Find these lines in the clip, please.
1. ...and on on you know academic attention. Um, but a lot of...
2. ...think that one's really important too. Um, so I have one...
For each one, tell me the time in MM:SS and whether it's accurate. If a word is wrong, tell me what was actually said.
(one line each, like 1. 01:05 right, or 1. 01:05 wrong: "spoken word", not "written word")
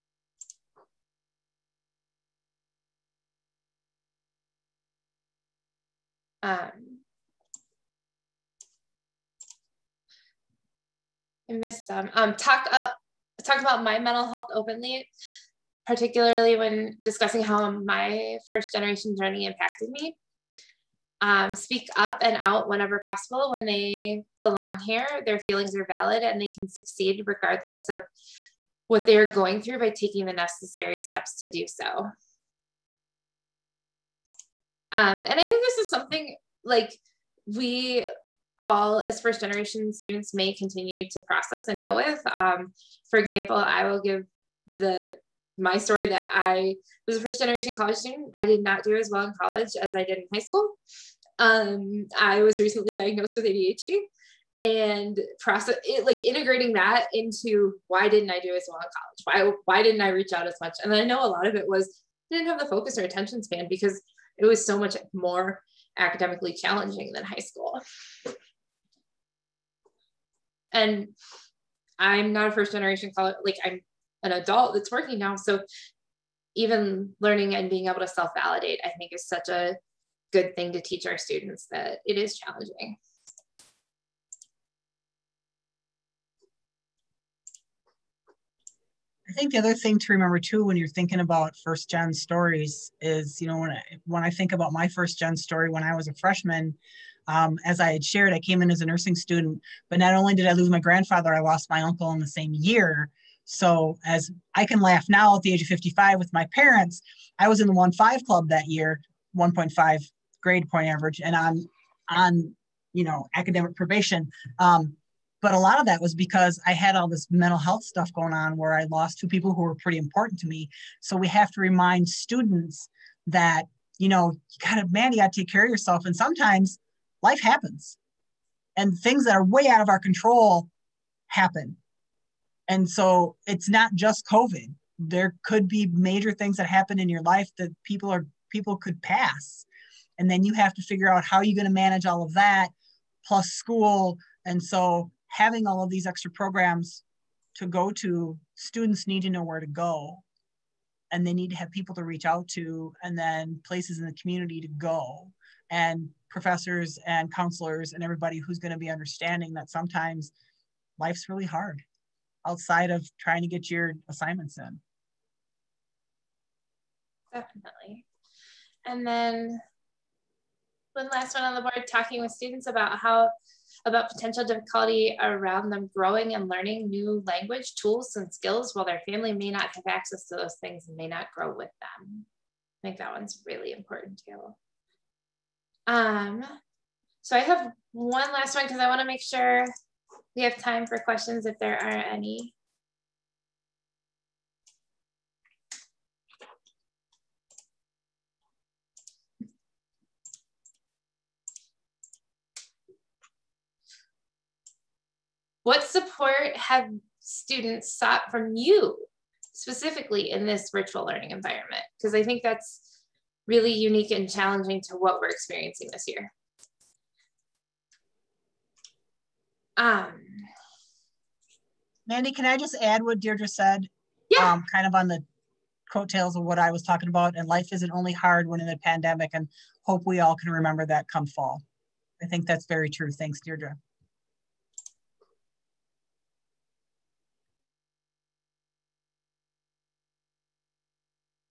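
1. 01:51 wrong: "probation", not "attention"
2. 03:02 right.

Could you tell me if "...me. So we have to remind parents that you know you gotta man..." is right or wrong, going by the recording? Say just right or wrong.
wrong.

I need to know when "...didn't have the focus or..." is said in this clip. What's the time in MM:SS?
01:02.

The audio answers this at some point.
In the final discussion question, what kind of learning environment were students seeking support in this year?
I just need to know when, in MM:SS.
03:30.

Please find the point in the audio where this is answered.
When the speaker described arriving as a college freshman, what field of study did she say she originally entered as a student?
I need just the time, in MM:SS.
01:38.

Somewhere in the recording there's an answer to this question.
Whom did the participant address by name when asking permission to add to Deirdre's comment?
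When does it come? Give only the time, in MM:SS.
03:42.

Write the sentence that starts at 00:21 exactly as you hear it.
Um, speak up and out whenever possible when they belong here.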